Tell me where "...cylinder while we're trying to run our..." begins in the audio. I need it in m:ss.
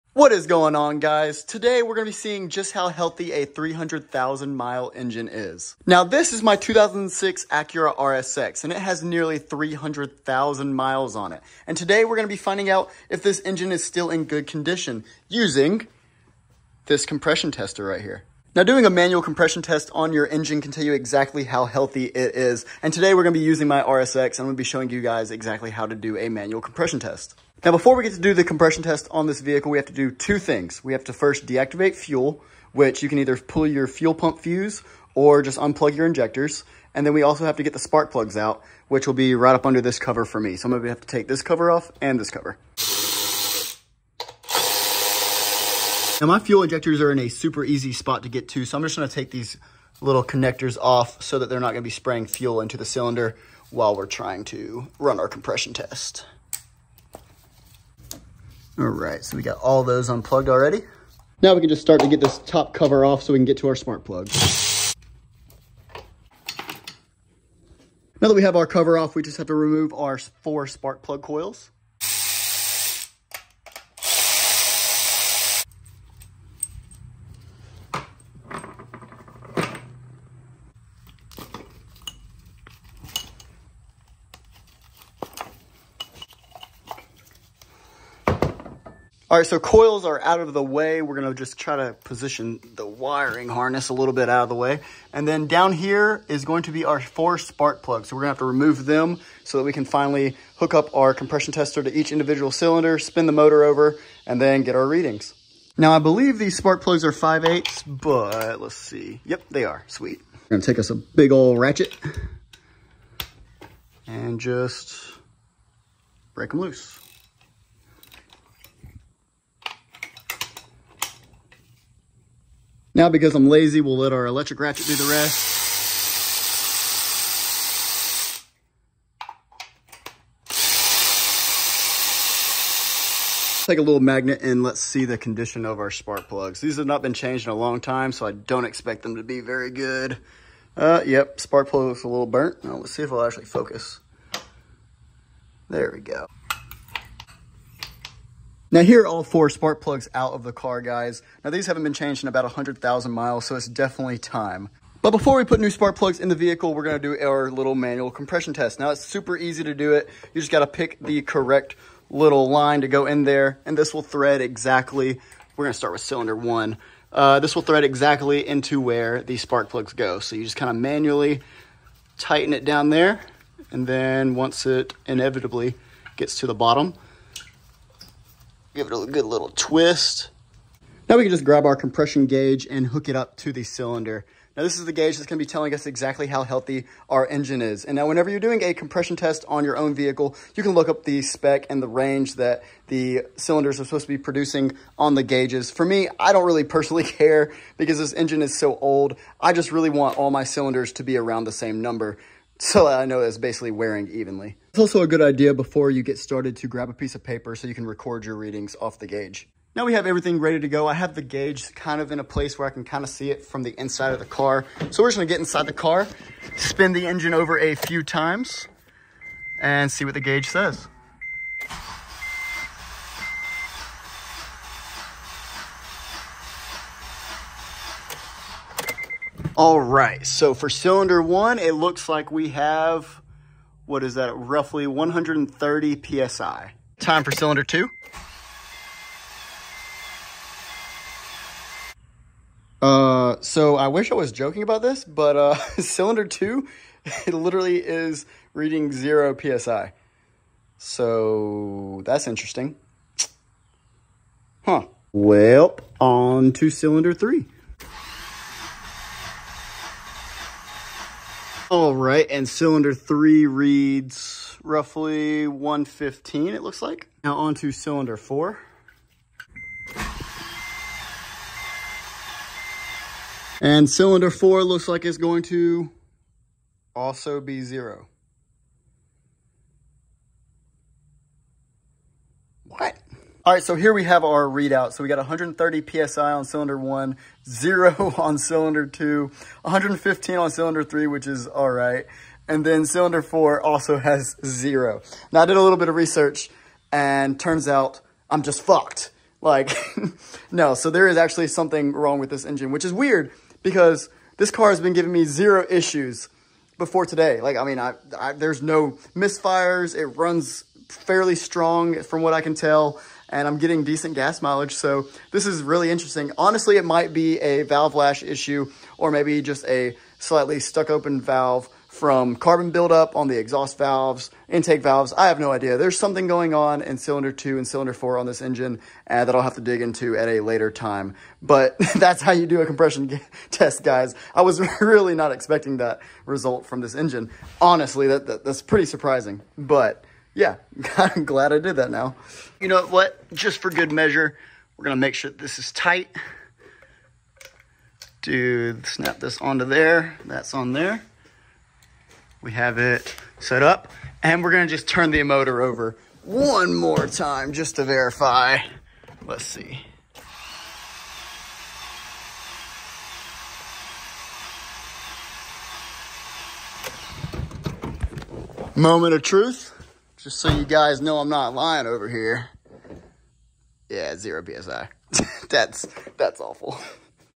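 0:52.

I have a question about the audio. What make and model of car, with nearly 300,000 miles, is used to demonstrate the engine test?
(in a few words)
2006 Acura RSX.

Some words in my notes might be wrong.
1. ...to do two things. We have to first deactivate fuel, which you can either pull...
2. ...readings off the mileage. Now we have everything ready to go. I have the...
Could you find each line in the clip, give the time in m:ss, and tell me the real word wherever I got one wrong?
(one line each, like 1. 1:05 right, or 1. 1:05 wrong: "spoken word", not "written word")
1. 0:29 right
2. 3:28 wrong: "gauge", not "mileage".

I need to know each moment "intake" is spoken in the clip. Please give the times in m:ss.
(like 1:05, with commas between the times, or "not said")
5:24.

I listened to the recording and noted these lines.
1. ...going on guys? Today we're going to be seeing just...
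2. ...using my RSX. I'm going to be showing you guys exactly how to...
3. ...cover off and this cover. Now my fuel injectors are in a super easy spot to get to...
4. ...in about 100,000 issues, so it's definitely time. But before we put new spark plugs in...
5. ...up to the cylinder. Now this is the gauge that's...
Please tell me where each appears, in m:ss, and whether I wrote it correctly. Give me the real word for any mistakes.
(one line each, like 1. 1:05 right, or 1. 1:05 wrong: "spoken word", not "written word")
1. 0:00 right
2. 0:23 right
3. 0:41 right
4. 2:32 wrong: "miles", not "issues"
5. 3:03 right.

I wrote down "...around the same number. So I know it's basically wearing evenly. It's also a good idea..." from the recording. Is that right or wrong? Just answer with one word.
right.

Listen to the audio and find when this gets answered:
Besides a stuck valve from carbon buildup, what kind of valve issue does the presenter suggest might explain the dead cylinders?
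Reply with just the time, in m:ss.
5:17.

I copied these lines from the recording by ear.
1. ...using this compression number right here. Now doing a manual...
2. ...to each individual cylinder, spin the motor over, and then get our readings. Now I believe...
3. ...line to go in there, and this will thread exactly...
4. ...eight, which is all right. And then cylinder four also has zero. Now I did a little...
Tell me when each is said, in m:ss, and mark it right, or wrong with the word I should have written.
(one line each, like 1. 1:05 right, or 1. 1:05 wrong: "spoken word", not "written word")
1. 0:15 wrong: "tester", not "number"
2. 1:41 right
3. 2:42 right
4. 4:50 wrong: "three", not "eight".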